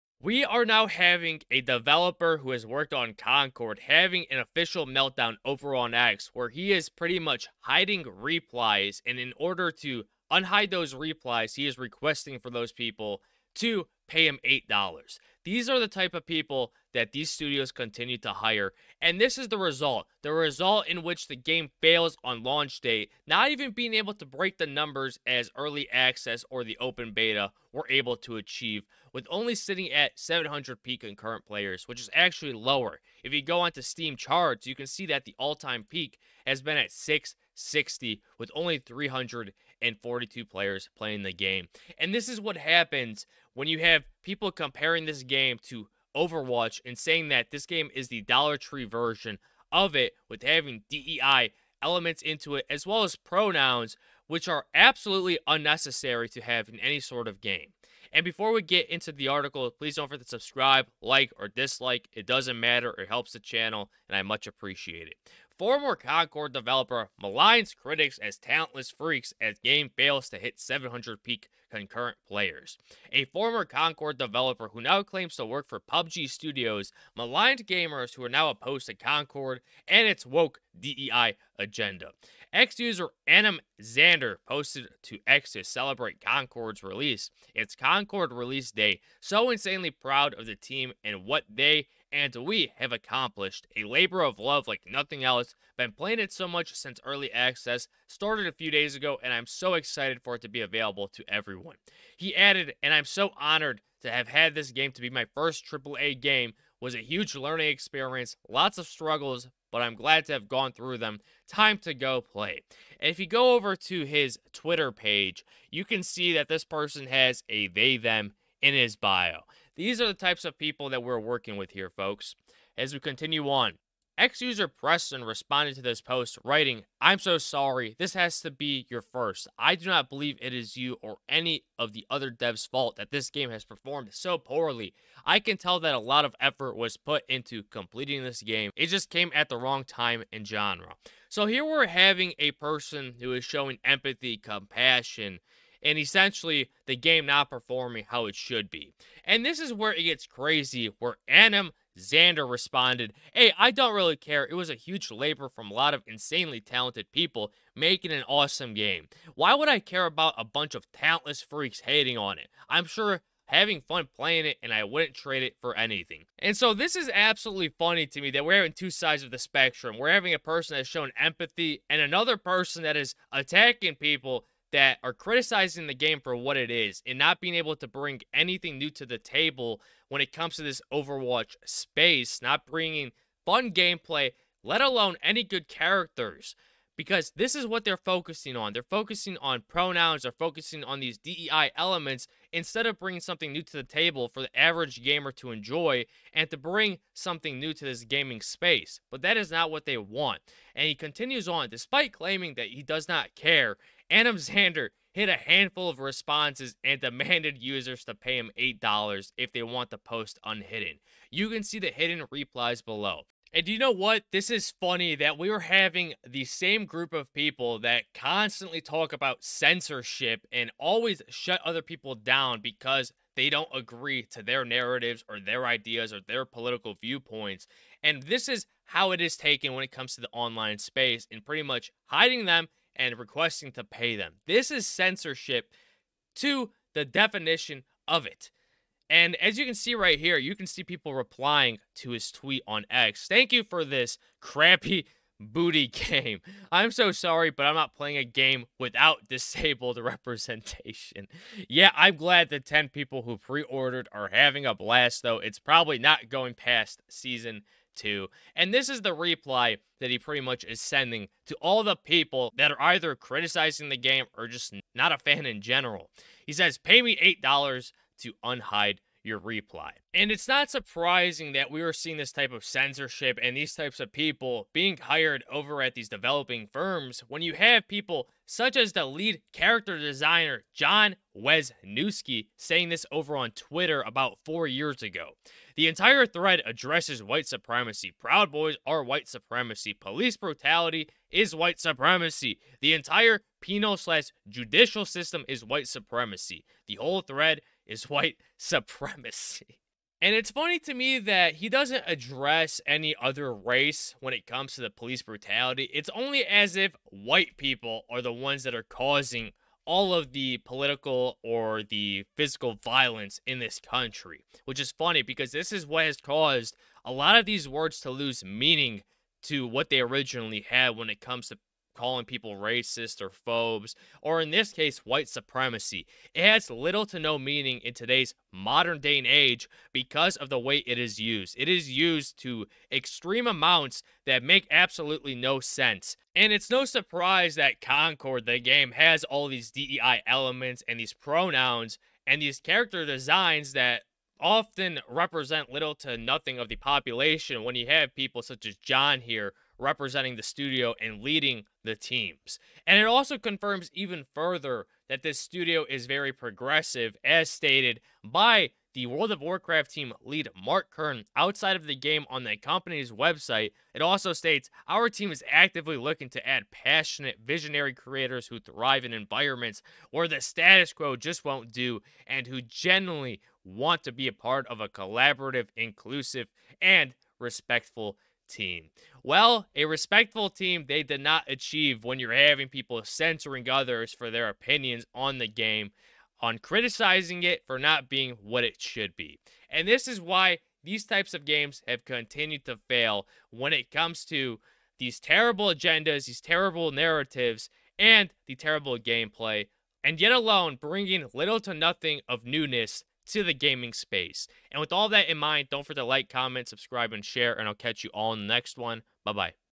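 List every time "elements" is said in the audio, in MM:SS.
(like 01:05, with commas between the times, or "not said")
00:51, 03:11, 05:40.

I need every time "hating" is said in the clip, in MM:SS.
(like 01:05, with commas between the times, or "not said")
02:41.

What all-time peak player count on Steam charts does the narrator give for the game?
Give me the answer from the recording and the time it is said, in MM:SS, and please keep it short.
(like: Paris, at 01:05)
660, at 00:36.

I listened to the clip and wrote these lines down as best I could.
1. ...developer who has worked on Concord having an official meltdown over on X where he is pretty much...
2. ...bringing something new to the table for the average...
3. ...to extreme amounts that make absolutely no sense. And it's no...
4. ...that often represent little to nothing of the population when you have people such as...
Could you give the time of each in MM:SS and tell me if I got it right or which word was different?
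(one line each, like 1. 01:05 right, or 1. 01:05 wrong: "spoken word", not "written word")
1. 00:01 right
2. 03:12 right
3. 05:32 right
4. 05:43 right.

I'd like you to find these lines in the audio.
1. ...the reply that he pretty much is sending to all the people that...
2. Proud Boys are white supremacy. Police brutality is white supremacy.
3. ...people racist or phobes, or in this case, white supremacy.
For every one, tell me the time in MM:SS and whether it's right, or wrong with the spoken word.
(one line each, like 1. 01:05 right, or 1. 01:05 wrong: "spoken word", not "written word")
1. 04:19 right
2. 04:48 right
3. 05:22 right.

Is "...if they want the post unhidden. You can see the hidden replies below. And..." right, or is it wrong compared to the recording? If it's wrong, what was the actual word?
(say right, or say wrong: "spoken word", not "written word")
right.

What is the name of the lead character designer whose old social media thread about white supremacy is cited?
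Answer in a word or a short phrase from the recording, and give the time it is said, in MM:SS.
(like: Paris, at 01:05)
John Weisnewski, at 04:40.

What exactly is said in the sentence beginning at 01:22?
Ex user Anim Xander posted to X to celebrate Concord's release.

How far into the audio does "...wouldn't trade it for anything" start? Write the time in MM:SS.
02:44.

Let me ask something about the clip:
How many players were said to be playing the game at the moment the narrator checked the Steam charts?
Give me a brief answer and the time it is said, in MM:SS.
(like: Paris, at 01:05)
342, at 00:38.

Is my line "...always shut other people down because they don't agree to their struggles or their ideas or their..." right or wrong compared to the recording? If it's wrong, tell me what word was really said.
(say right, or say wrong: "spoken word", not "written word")
wrong: "narratives", not "struggles".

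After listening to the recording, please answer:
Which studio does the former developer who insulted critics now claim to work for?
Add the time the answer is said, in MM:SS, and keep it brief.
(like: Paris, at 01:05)
PUBG Studios, at 01:15.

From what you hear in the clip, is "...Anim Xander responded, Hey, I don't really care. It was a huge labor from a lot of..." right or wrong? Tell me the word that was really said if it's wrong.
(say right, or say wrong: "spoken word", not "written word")
right.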